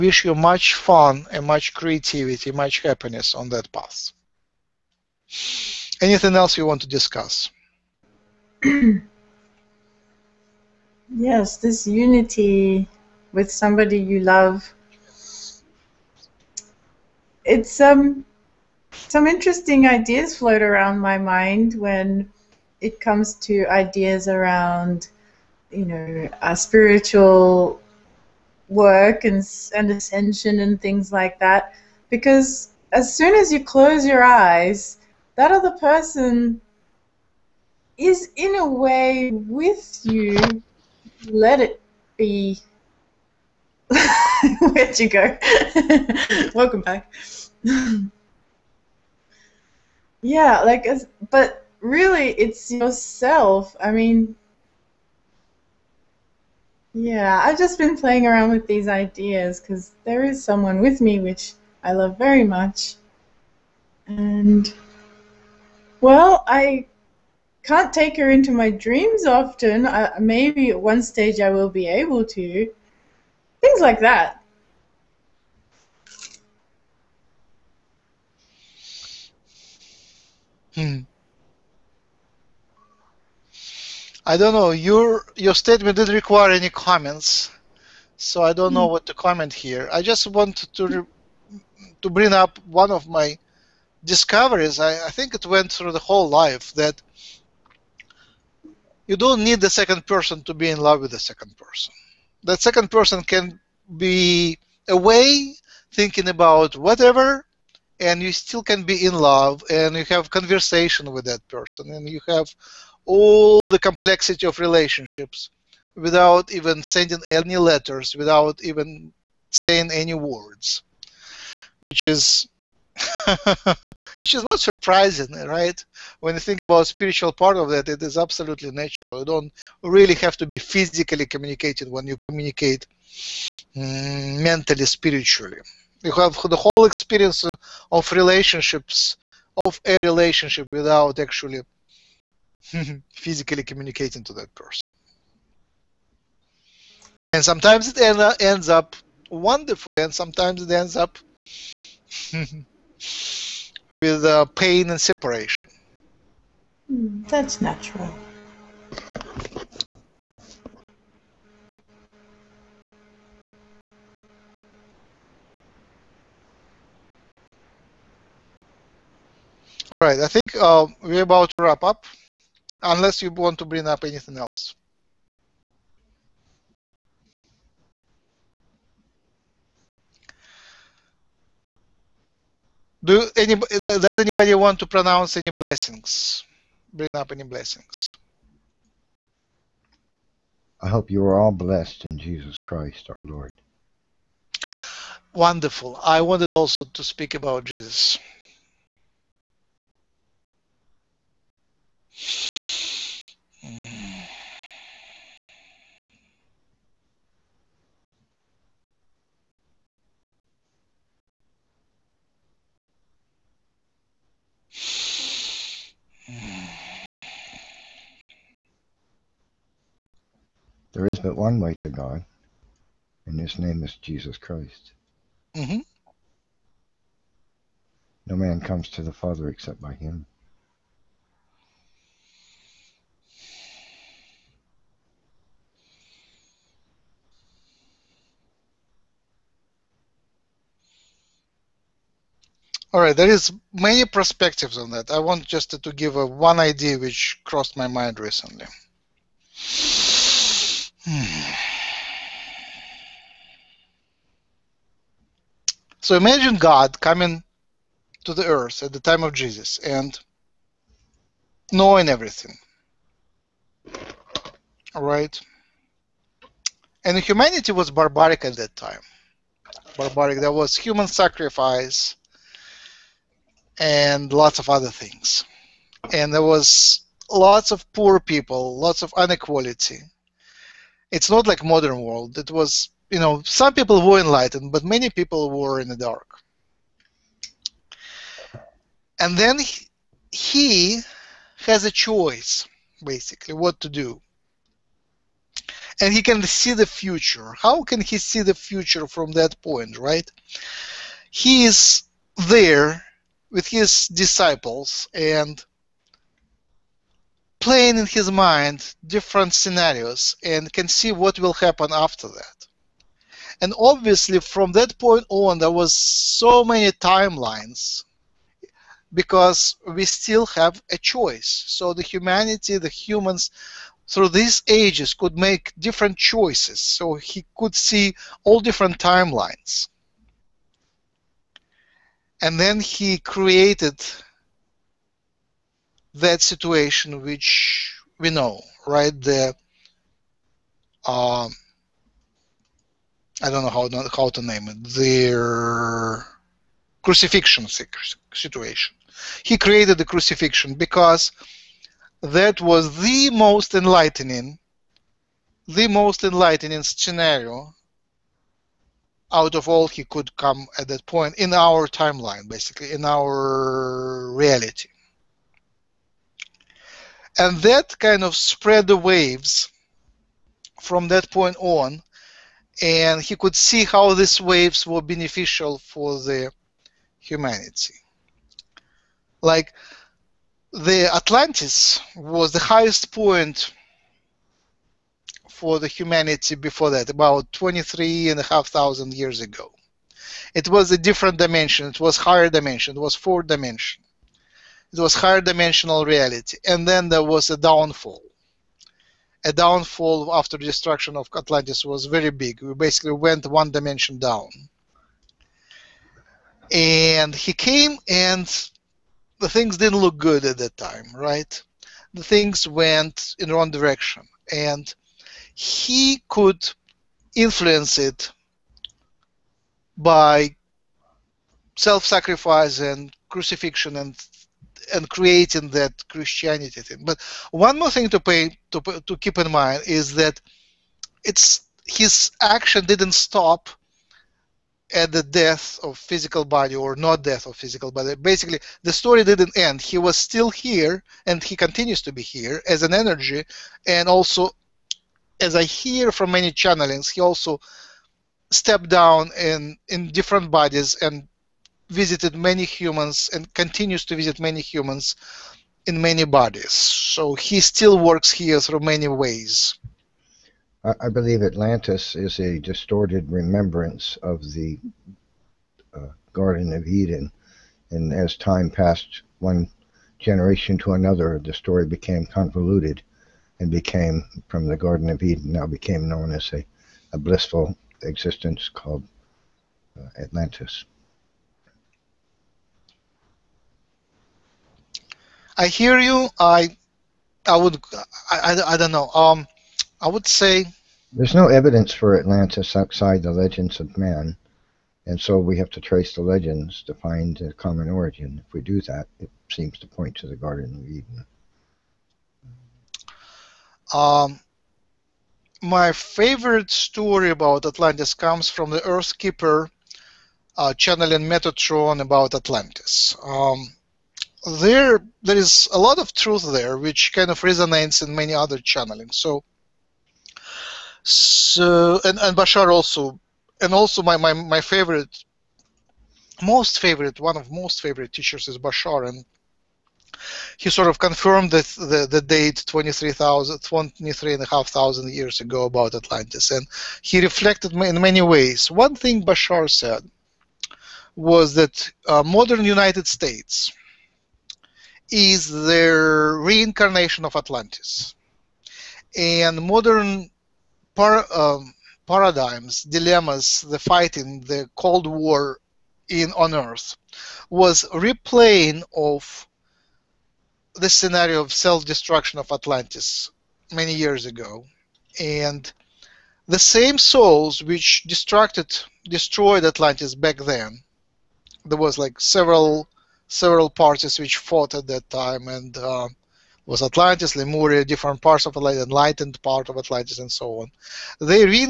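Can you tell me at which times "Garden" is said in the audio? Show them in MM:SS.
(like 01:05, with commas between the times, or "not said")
07:46, 07:54, 08:20.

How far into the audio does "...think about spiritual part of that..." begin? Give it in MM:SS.
02:06.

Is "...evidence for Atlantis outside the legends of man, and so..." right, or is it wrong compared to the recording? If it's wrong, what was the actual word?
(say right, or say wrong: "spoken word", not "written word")
right.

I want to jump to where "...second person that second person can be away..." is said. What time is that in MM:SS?
01:41.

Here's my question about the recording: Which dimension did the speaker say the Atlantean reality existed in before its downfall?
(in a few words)
Fourth dimension.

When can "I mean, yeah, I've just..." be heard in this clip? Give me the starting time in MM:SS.
00:53.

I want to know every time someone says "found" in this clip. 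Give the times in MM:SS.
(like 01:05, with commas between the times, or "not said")
not said.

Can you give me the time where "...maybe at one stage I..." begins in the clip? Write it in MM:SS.
01:10.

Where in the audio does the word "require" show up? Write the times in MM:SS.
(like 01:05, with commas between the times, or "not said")
01:26.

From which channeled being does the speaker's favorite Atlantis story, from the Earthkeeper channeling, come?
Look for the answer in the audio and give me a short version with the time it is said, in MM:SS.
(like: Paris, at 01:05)
Metatron, at 08:31.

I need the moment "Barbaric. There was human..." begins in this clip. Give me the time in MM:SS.
04:29.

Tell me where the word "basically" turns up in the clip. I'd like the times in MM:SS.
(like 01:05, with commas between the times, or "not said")
04:53, 06:02, 06:42, 07:18.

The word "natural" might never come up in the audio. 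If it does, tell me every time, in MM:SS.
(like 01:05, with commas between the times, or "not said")
02:08, 02:37.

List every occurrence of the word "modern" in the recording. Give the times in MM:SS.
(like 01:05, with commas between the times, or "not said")
04:41, 09:02, 09:09.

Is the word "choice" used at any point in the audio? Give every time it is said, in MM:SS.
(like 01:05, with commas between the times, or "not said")
04:51, 05:20, 05:26.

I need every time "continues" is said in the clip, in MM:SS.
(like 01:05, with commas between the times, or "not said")
07:21, 07:33.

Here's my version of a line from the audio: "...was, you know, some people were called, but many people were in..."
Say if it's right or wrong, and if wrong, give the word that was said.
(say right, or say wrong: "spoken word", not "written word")
wrong: "enlightened", not "called".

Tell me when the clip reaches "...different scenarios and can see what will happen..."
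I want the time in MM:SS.
05:09.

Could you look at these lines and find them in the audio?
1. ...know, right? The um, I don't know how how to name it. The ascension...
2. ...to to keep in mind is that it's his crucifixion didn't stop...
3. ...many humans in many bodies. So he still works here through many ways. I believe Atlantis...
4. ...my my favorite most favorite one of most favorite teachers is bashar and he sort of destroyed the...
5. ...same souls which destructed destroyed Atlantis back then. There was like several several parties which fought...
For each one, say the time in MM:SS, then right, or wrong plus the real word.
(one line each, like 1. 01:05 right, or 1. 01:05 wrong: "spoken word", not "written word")
1. 05:38 wrong: "crucifixion", not "ascension"
2. 07:08 wrong: "action", not "crucifixion"
3. 07:34 right
4. 08:44 wrong: "confirmed", not "destroyed"
5. 09:26 right.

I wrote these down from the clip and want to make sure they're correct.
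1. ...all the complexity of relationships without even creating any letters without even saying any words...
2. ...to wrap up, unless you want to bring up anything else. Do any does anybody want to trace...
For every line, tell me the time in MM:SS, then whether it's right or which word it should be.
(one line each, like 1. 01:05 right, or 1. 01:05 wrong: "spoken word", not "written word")
1. 01:53 wrong: "sending", not "creating"
2. 02:51 wrong: "pronounce", not "trace".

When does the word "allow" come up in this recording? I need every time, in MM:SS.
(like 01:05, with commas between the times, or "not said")
not said.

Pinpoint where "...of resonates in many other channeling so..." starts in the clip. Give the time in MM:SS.
08:37.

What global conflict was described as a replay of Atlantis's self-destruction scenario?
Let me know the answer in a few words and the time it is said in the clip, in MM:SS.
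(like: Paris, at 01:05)
The Cold War, at 09:14.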